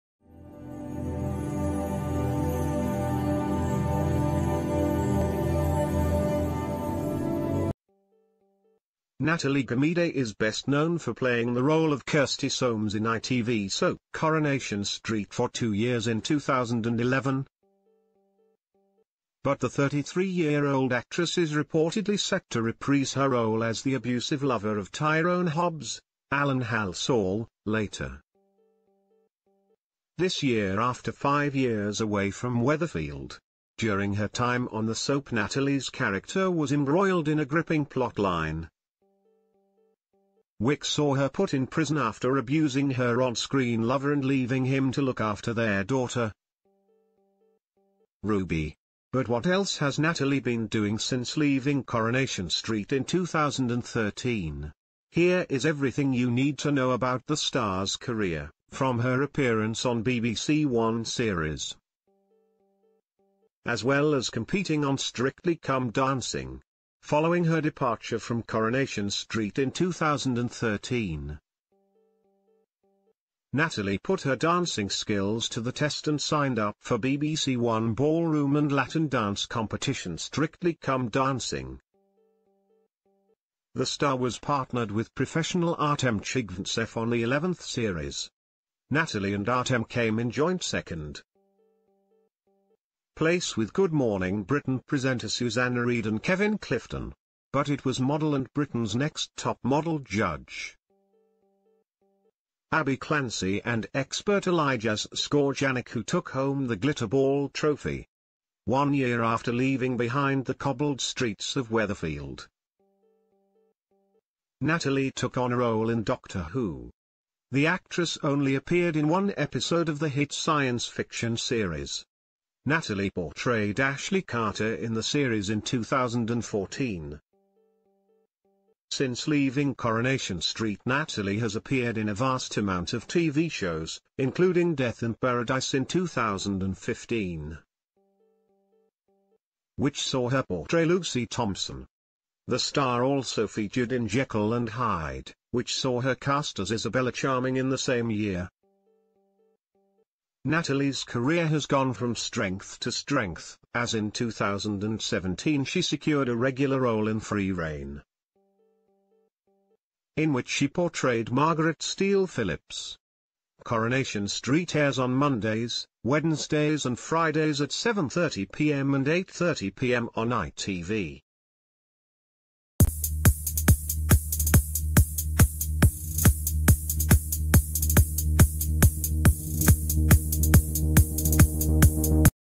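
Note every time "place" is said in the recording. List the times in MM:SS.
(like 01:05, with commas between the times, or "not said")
01:33.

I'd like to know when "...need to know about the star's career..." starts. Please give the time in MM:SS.
00:56.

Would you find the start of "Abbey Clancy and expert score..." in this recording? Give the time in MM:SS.
01:42.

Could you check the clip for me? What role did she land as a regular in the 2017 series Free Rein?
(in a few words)
Margaret Steele Phillips.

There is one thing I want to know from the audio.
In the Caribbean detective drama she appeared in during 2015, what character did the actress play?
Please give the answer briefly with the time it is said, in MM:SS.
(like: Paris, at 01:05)
Lucy Thompson, at 02:20.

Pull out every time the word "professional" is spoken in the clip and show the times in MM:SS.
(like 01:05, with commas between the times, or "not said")
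01:25.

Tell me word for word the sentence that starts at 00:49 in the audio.
But what else has Natalie been doing since leaving Coronation Street in 2013?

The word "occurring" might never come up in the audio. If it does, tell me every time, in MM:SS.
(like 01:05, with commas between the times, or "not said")
not said.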